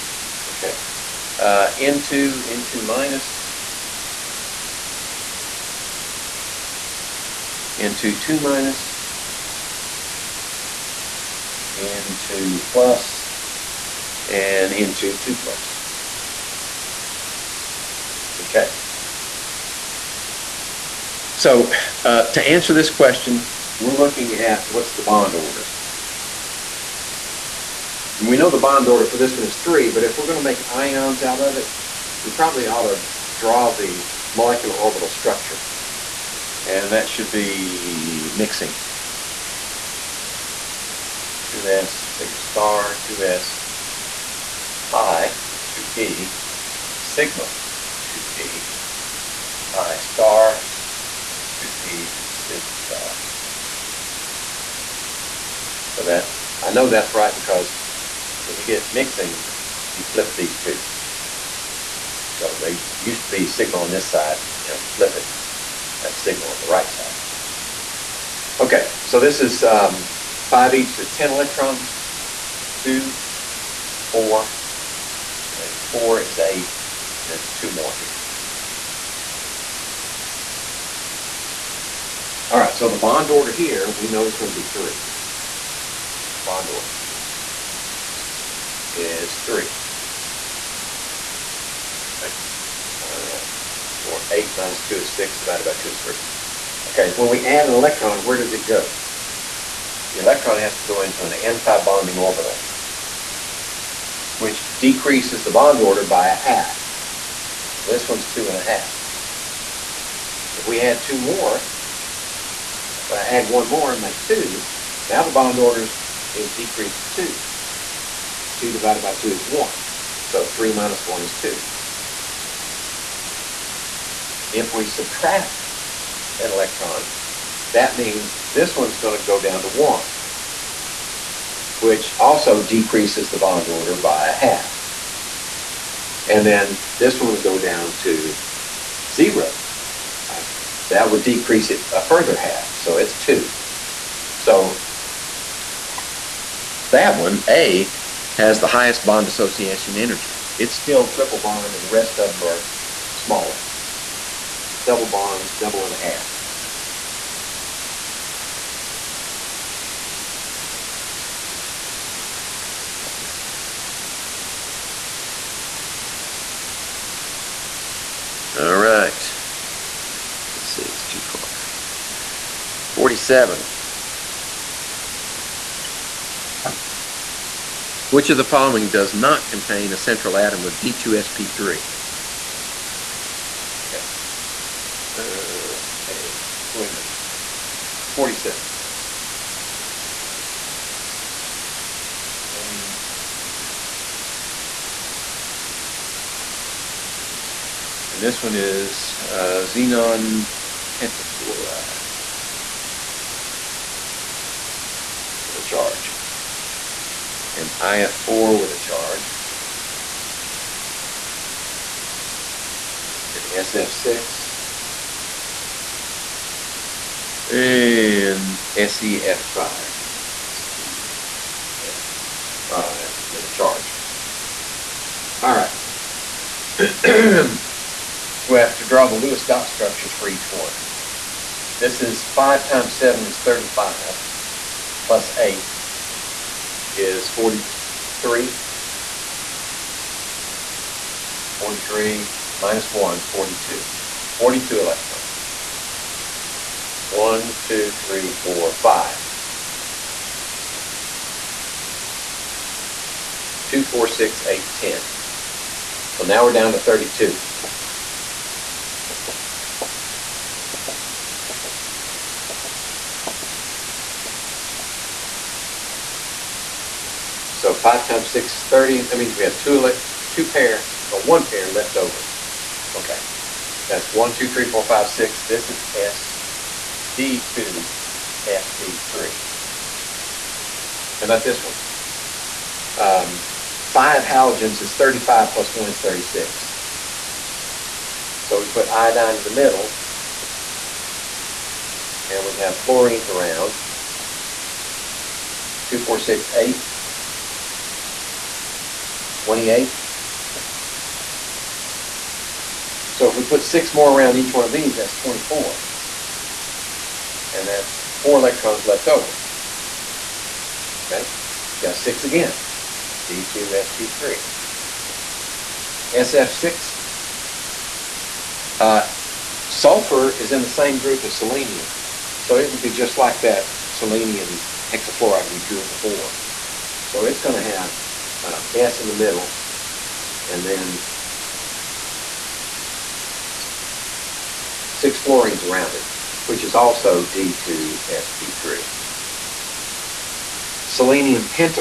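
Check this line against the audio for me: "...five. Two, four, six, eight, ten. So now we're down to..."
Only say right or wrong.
right.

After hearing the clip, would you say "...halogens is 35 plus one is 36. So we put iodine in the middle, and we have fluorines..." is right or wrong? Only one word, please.
right.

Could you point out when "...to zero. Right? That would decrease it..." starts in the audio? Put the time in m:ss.
2:17.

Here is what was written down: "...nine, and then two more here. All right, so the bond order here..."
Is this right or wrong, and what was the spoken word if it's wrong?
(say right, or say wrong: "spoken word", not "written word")
wrong: "eight", not "nine".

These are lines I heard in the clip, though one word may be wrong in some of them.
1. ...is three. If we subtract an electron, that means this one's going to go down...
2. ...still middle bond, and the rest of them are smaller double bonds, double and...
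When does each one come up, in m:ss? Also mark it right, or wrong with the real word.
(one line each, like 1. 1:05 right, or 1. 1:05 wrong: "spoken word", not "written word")
1. 2:01 wrong: "two", not "three"
2. 2:30 wrong: "triple", not "middle".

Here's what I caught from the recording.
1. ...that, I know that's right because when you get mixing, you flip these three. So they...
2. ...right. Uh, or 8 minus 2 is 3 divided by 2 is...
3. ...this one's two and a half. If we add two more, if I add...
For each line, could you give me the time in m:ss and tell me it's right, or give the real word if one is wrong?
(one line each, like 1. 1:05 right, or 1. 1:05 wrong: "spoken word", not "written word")
1. 0:56 wrong: "two", not "three"
2. 1:32 wrong: "6", not "3"
3. 1:47 right.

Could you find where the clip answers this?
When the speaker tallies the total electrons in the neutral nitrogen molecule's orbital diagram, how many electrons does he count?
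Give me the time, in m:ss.
1:11.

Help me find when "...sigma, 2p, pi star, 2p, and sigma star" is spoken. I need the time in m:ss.
0:46.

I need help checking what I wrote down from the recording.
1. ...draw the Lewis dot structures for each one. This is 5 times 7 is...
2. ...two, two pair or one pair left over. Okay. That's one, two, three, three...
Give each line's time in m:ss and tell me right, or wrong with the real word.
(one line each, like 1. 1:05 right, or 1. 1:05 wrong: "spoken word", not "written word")
1. 3:48 right
2. 4:29 wrong: "four", not "three".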